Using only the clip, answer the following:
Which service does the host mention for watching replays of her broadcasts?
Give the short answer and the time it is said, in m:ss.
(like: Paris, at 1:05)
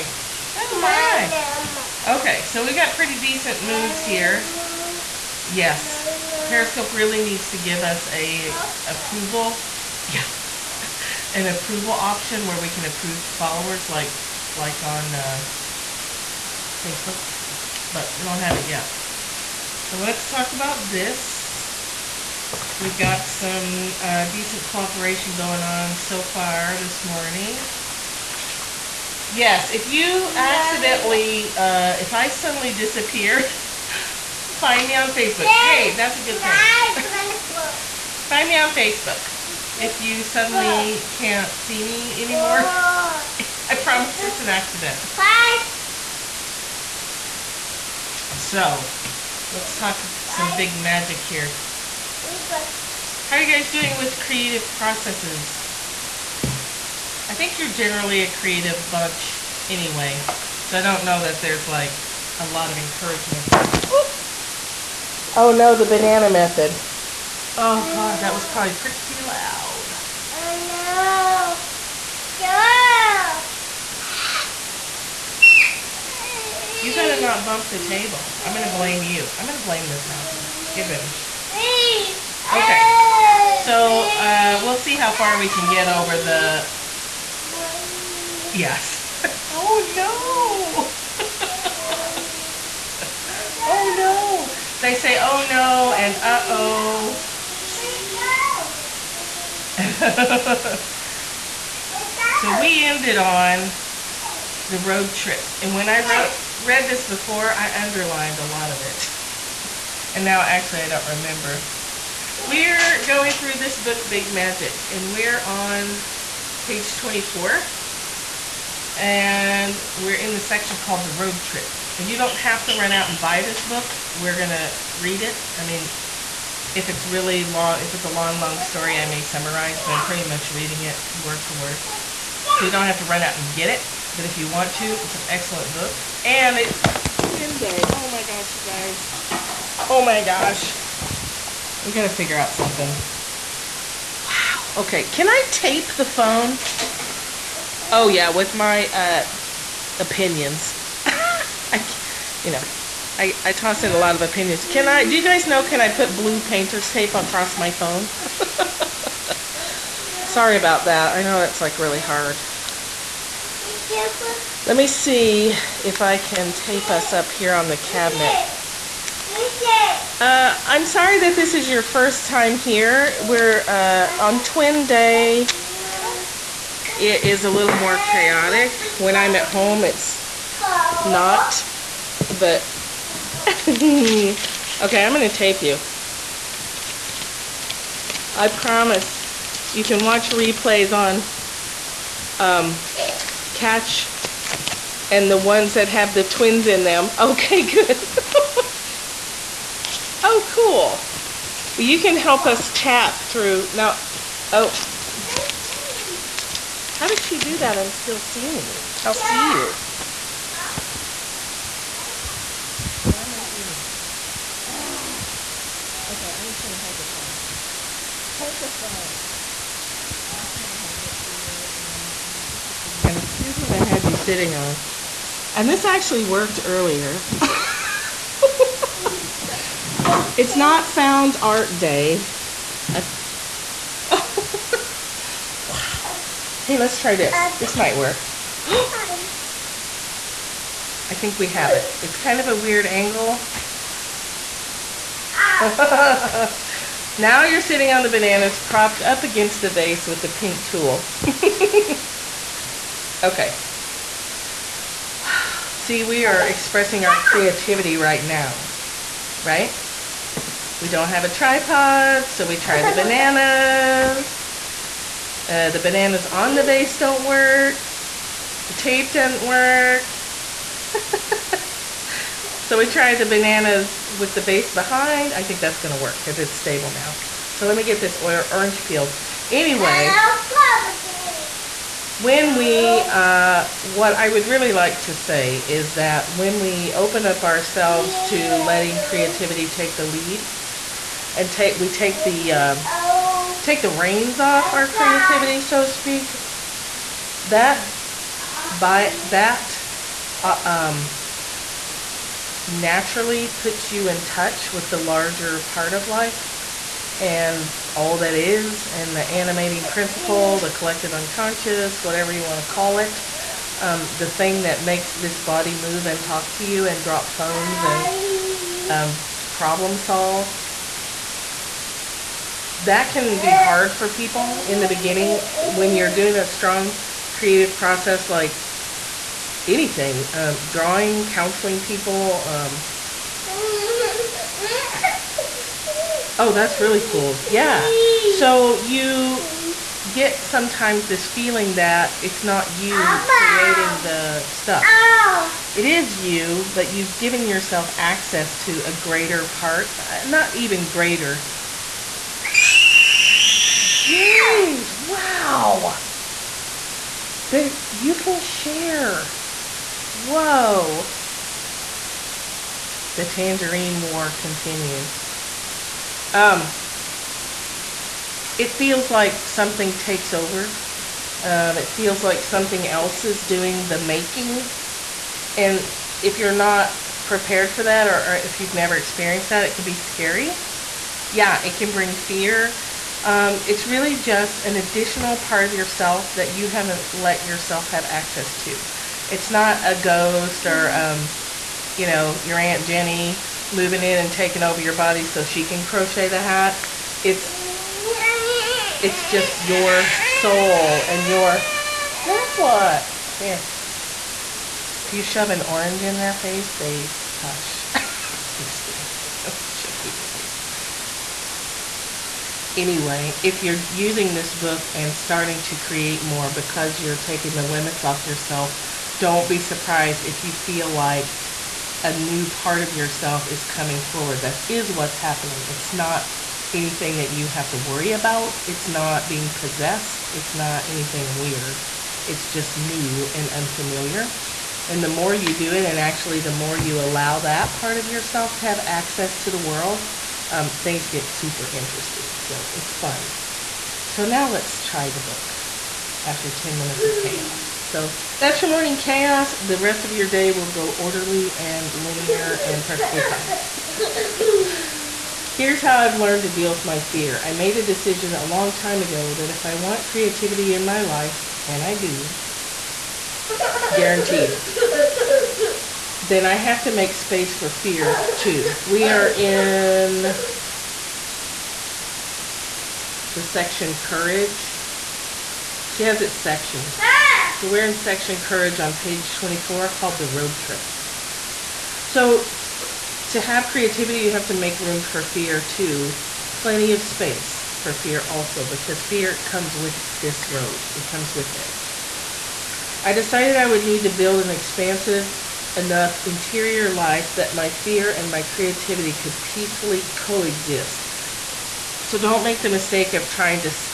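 Katch, at 3:13.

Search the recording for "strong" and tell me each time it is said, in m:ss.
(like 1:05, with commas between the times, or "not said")
5:26.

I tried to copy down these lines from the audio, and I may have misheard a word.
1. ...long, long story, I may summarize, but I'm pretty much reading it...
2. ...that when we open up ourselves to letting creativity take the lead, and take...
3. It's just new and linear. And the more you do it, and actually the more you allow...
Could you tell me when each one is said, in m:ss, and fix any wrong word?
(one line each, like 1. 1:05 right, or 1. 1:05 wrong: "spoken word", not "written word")
1. 2:08 right
2. 4:45 right
3. 7:12 wrong: "unfamiliar", not "linear".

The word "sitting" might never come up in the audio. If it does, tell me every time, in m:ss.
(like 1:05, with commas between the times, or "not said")
3:44, 4:07.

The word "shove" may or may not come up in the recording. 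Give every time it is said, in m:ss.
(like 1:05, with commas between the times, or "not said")
6:45, 6:49.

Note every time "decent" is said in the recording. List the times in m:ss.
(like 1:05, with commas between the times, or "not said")
0:03, 0:24.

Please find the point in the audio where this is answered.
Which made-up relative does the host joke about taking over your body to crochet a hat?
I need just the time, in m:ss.
6:32.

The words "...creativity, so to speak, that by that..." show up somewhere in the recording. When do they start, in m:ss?
4:54.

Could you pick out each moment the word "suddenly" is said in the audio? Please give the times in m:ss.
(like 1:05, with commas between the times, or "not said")
0:32, 0:40.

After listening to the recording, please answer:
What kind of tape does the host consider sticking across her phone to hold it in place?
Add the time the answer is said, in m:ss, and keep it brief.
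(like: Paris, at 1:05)
blue painter's tape, at 2:36.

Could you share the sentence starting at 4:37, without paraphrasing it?
So let me get this orange peeled.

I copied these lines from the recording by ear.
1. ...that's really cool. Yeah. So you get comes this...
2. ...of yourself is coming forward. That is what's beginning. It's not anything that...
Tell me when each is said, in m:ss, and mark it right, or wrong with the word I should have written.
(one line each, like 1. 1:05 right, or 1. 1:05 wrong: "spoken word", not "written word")
1. 5:36 wrong: "sometimes", not "comes"
2. 7:02 wrong: "happening", not "beginning".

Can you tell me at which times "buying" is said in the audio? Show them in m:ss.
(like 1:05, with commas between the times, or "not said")
not said.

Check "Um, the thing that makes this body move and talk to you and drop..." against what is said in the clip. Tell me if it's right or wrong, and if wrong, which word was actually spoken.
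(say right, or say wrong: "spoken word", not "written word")
right.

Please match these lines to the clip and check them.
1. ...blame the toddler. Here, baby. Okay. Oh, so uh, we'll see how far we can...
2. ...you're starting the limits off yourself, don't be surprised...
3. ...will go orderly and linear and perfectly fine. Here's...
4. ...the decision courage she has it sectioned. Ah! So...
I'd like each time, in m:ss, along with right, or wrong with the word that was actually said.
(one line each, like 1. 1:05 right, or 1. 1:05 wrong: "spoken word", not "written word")
1. 1:19 right
2. 6:57 wrong: "taking", not "starting"
3. 7:30 right
4. 7:53 wrong: "section", not "decision".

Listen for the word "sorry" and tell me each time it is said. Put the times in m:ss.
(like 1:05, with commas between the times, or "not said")
2:40, 2:50.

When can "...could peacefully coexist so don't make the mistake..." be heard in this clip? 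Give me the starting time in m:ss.
8:19.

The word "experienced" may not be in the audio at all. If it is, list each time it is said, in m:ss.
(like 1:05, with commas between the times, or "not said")
6:18.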